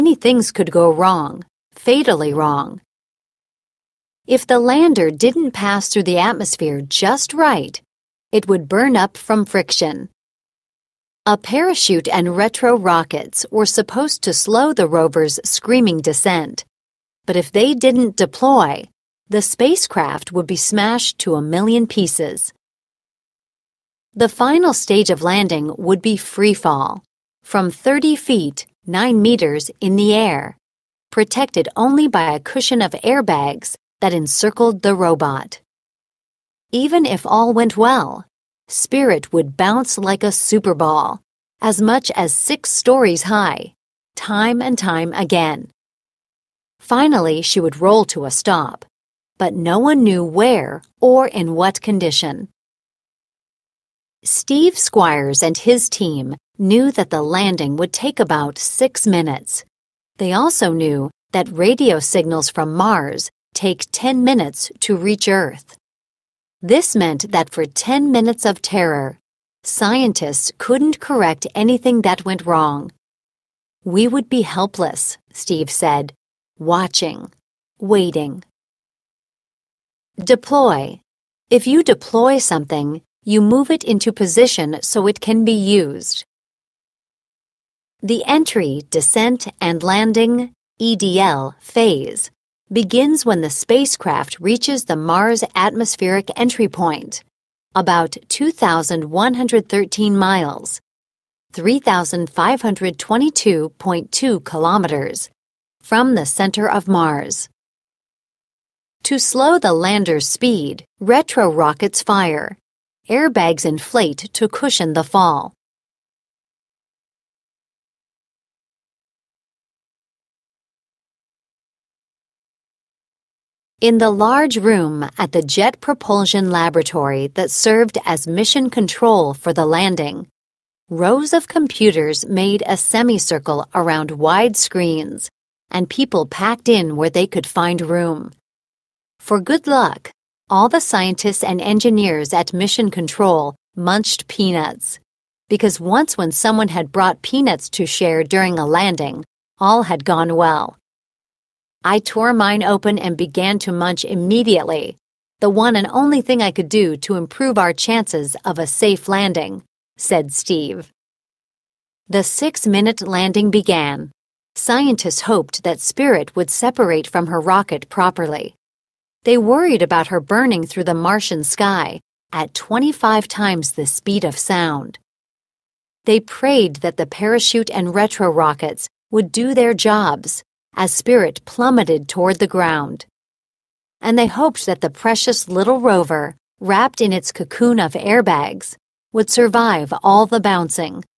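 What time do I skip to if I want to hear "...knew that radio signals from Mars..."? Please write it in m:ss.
1:00.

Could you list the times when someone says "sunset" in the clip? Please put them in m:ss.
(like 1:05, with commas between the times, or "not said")
not said.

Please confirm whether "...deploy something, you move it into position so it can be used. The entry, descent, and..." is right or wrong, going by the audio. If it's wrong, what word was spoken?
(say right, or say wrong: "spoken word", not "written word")
right.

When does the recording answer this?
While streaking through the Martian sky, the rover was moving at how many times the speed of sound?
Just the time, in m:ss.
2:52.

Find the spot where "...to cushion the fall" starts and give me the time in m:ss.
1:54.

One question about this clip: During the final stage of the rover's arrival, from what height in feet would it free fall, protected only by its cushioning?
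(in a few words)
30 feet.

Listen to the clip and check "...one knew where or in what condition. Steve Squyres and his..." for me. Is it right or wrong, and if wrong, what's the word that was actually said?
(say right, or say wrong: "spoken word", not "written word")
right.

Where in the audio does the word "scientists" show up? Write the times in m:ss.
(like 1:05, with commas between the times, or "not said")
1:09, 2:20, 2:44.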